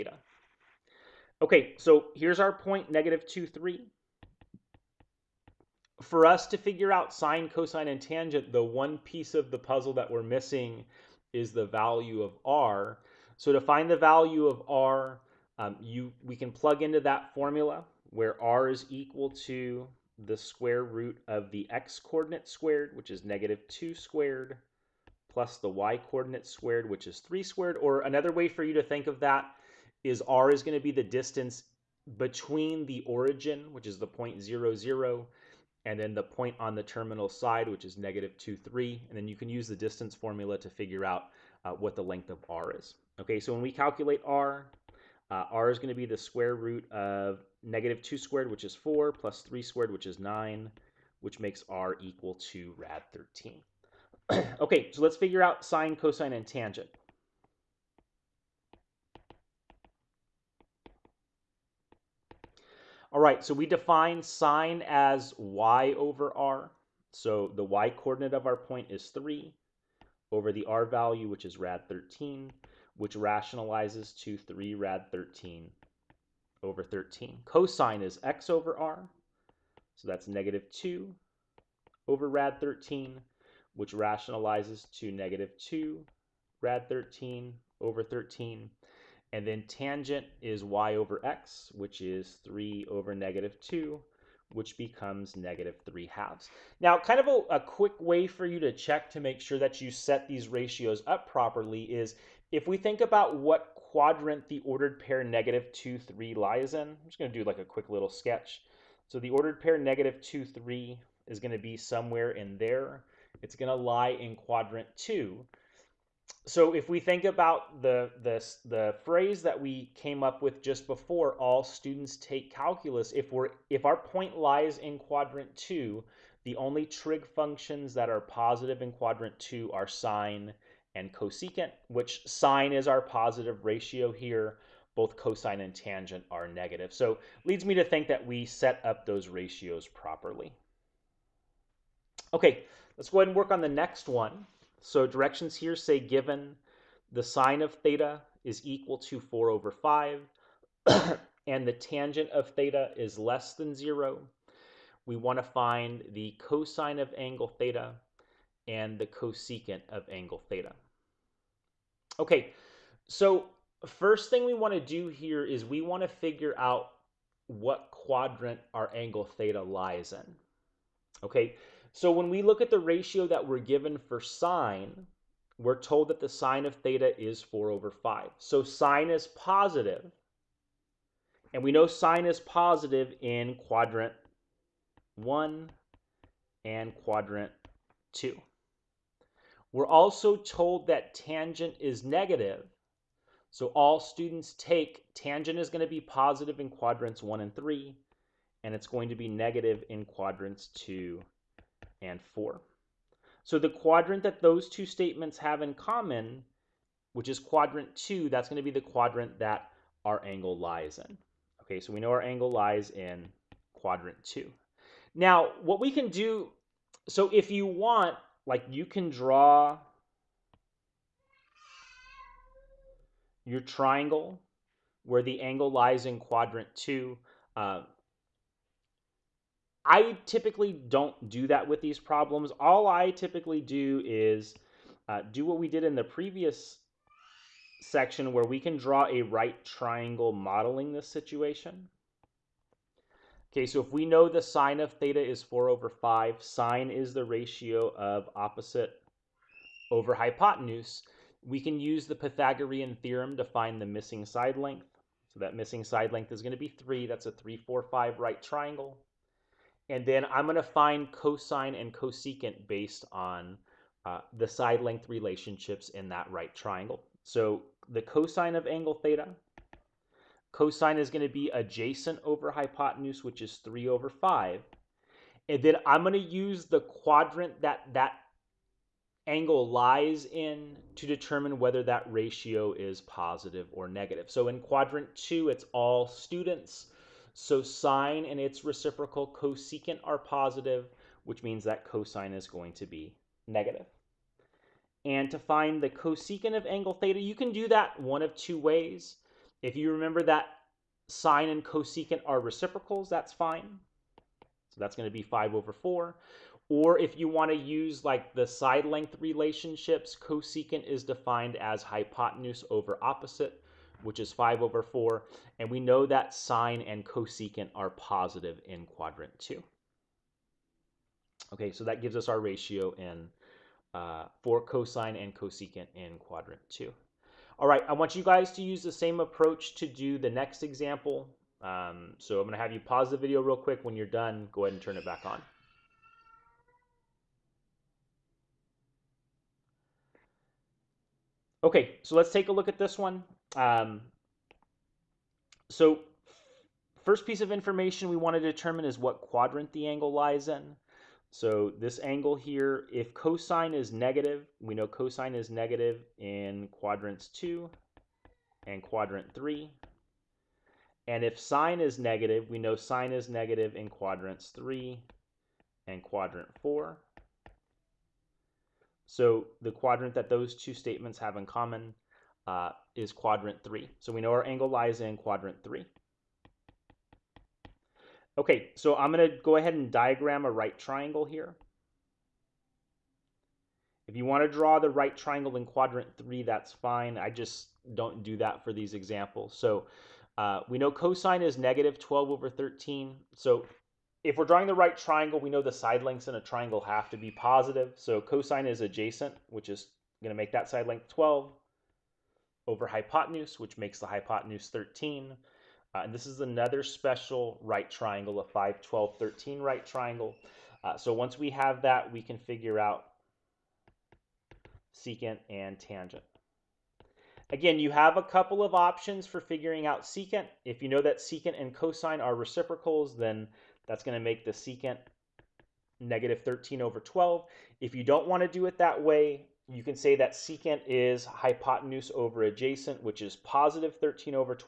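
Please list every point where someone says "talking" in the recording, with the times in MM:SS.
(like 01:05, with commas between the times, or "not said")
not said.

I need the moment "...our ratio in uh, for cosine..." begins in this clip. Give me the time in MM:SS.
05:22.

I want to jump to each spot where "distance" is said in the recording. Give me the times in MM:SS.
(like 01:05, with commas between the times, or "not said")
00:31, 00:39.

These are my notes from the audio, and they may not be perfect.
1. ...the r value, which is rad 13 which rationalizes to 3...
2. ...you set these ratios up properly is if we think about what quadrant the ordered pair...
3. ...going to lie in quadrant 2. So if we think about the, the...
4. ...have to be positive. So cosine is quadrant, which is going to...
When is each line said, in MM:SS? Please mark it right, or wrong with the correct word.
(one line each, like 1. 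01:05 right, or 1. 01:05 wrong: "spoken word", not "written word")
1. 01:10 right
2. 01:39 right
3. 01:53 right
4. 06:36 wrong: "adjacent", not "quadrant".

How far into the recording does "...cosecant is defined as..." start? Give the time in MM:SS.
05:10.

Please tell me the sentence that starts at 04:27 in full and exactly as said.
So the cosine of angle theta Cosine is going to be adjacent over hypotenuse, which is 3 over 5.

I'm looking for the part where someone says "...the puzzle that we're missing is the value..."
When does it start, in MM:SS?
00:09.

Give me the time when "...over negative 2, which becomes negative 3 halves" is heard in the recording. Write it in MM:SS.
01:32.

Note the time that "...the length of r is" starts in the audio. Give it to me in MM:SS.
00:41.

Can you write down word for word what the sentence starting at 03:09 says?
We're also told that tangent is negative.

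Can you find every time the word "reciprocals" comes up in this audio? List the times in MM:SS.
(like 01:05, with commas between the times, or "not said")
04:48, 05:02, 07:02.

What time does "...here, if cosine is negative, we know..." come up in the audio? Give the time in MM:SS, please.
05:52.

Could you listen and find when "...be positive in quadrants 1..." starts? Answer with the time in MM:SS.
03:15.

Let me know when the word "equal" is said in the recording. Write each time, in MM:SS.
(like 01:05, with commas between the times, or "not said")
00:18, 00:52, 02:28.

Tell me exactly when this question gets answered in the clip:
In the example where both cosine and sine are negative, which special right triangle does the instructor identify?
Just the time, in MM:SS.
06:48.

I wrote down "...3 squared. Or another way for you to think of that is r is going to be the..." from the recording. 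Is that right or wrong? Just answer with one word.
right.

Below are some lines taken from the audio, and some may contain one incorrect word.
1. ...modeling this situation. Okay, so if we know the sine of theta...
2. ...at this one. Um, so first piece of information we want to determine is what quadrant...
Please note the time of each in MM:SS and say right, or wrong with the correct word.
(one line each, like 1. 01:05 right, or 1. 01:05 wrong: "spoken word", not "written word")
1. 04:00 right
2. 05:42 right.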